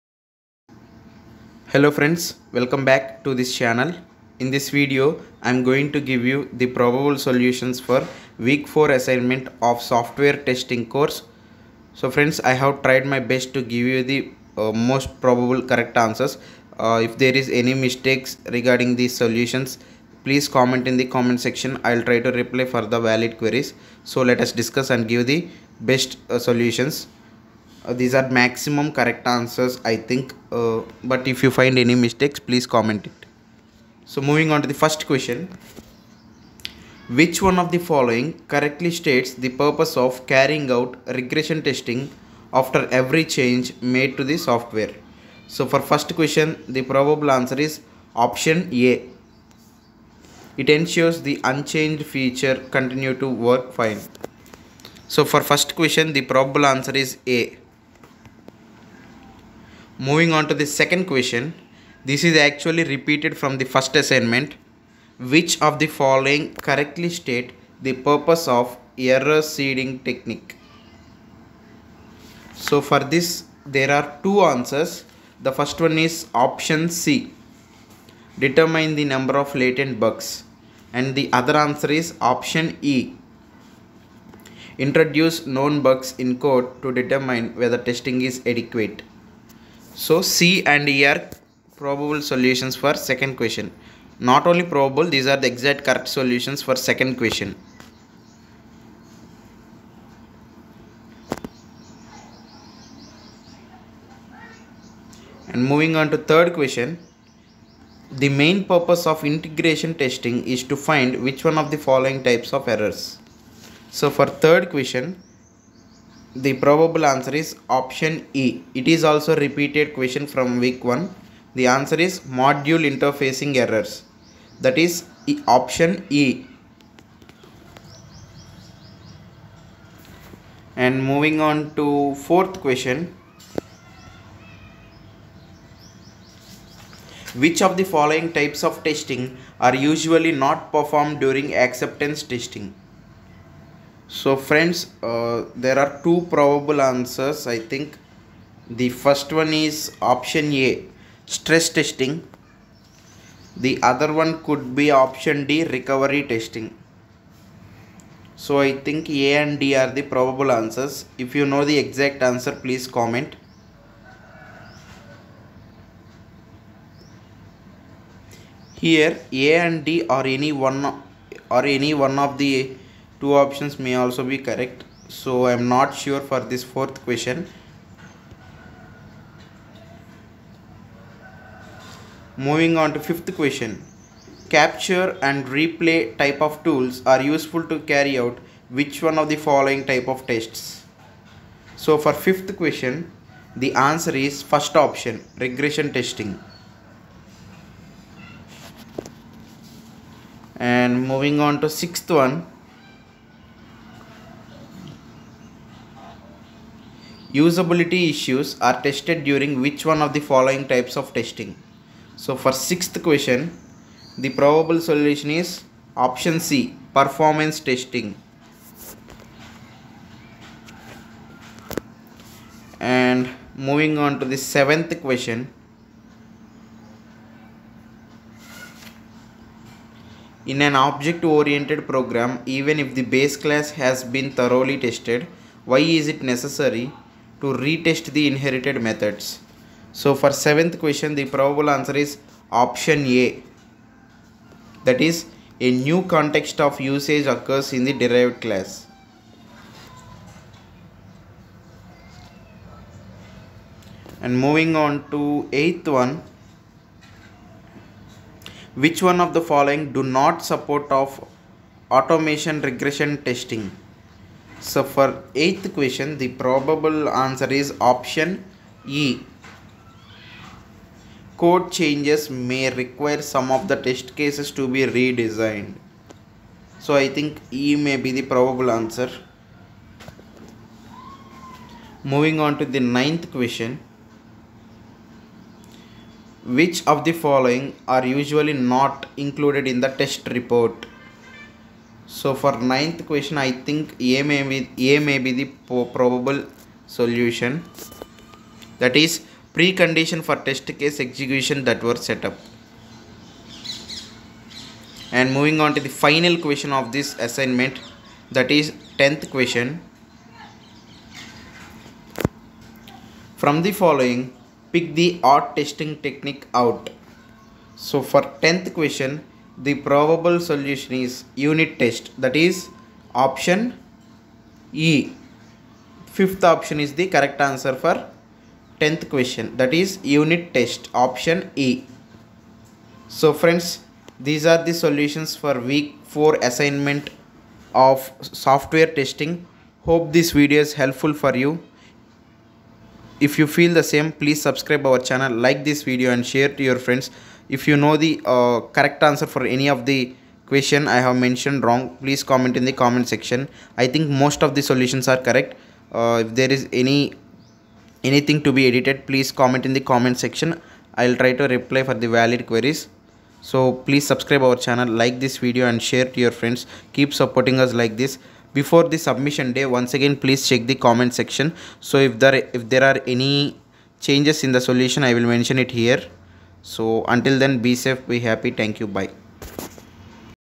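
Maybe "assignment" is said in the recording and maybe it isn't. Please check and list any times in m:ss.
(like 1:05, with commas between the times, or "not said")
0:08, 1:03, 5:07, 5:36.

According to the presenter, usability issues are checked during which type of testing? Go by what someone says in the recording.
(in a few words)
Performance testing.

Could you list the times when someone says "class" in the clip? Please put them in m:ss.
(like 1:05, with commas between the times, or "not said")
3:53, 4:08.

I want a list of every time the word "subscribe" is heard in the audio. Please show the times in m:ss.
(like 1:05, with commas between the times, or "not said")
5:44, 6:04.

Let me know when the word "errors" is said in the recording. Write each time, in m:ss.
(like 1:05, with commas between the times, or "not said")
1:08, 1:52, 2:03.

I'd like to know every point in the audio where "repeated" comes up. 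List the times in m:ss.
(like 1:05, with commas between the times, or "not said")
1:02, 1:59.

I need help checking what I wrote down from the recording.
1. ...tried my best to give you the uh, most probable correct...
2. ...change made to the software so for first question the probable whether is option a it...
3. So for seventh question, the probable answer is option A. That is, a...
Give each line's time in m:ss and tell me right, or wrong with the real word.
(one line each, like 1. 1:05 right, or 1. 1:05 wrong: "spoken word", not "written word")
1. 0:12 right
2. 0:43 wrong: "answer", not "whether"
3. 3:59 right.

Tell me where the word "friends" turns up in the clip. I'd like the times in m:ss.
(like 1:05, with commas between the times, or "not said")
0:01, 0:12, 2:24, 5:33, 5:46, 6:06.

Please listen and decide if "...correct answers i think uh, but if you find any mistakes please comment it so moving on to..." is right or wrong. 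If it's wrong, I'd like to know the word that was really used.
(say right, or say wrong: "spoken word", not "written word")
right.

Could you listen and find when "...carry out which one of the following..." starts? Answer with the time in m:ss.
3:07.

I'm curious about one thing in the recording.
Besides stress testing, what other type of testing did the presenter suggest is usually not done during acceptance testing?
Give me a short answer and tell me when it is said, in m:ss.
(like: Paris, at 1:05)
Recovery testing, at 2:35.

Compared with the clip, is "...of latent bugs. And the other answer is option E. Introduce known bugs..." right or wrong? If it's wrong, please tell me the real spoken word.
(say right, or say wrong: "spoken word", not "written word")
right.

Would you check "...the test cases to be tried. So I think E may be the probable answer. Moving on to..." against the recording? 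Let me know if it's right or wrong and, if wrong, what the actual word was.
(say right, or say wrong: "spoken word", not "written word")
wrong: "redesigned", not "tried".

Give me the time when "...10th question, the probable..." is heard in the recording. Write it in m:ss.
5:18.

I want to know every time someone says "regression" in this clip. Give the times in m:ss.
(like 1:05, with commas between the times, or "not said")
0:41, 3:15, 4:22.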